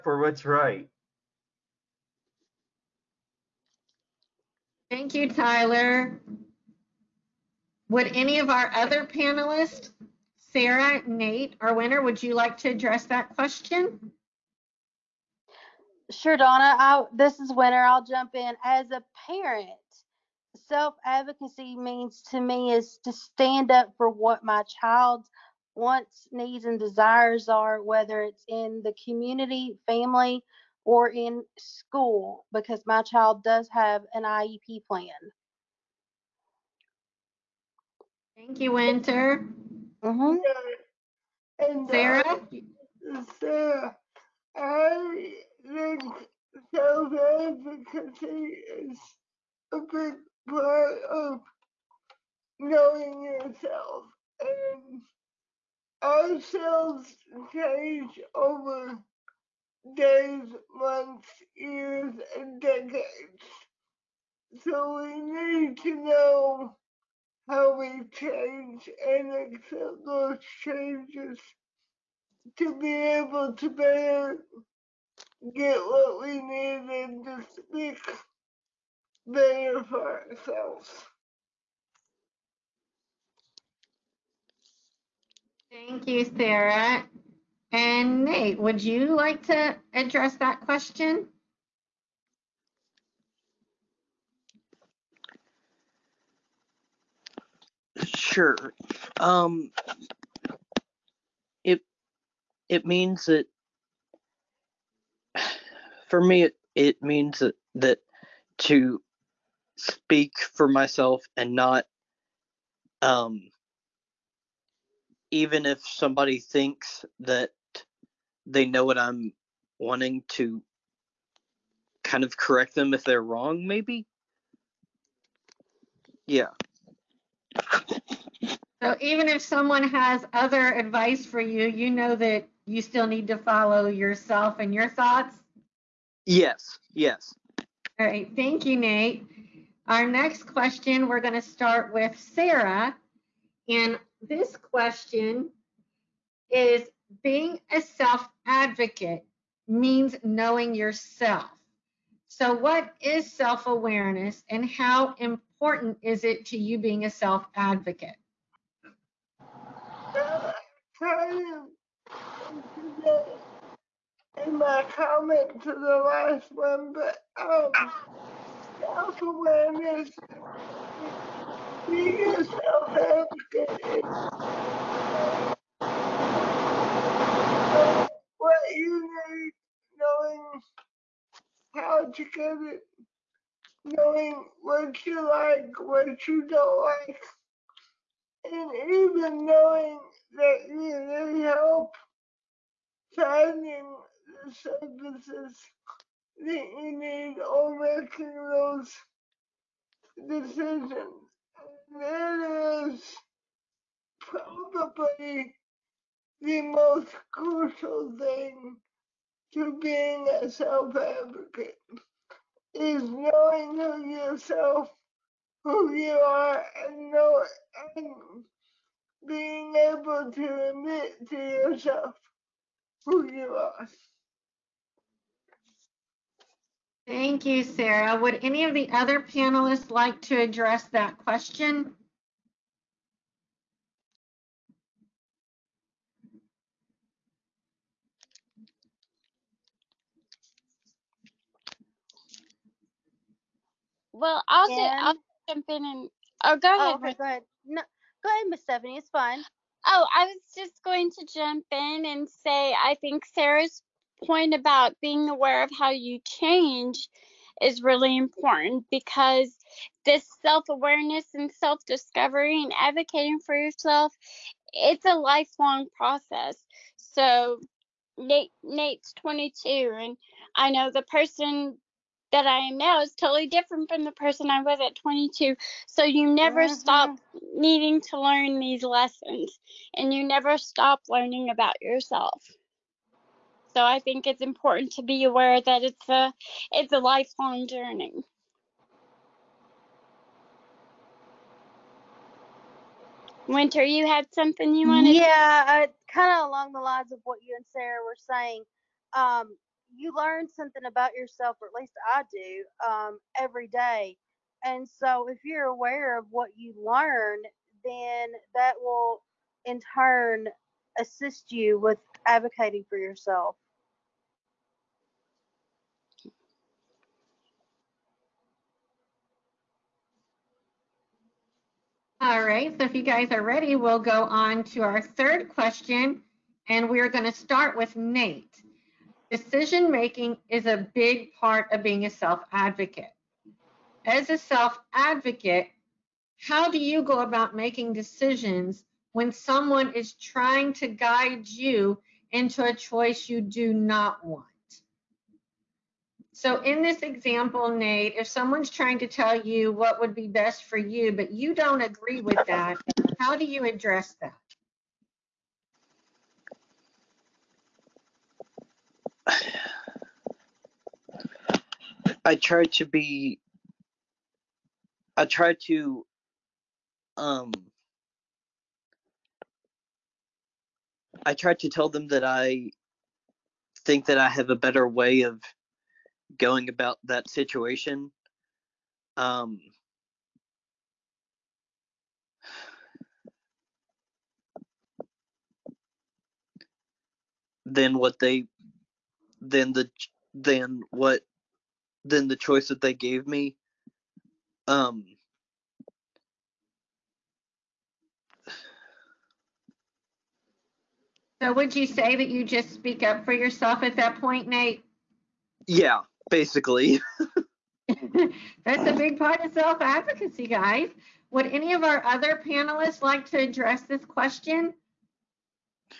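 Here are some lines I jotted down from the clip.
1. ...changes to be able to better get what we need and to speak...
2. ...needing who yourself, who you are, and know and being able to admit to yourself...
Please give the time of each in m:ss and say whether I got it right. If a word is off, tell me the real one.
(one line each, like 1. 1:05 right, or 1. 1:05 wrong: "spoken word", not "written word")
1. 1:10 right
2. 3:33 wrong: "knowing", not "needing".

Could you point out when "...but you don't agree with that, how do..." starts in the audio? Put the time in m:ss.
5:51.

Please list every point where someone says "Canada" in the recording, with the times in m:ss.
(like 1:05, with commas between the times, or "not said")
not said.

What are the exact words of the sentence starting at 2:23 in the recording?
And this question is being a self advocate means knowing yourself.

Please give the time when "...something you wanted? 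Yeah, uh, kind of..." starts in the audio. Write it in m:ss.
4:54.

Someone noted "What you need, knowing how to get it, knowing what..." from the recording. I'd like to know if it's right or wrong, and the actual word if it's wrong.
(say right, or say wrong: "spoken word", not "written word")
right.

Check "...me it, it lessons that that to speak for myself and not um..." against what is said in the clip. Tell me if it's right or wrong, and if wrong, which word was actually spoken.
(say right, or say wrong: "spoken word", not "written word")
wrong: "means", not "lessons".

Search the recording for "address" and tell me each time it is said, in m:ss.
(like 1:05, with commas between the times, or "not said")
0:12, 1:29, 3:50, 5:53, 6:53.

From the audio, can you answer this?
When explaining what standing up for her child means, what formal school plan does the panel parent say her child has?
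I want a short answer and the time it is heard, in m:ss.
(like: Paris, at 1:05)
IEP plan, at 0:34.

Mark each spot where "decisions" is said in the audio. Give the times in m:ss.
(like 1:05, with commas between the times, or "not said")
3:20, 5:29, 5:37.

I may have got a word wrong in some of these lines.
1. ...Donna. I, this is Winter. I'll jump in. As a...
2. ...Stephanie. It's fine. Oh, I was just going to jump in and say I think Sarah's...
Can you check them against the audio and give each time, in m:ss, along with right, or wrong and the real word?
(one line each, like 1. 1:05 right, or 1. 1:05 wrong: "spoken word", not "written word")
1. 0:16 right
2. 4:08 right.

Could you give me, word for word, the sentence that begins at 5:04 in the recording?
And so, if you're aware of what you learn, then that will in turn assist you with advocating for yourself.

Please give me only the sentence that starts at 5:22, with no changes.
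All right, so if you guys are ready, we'll go on to our third question, and we're going to start with Nate.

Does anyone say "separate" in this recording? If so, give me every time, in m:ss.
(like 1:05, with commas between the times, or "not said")
not said.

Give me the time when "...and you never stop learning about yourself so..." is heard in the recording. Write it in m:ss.
4:39.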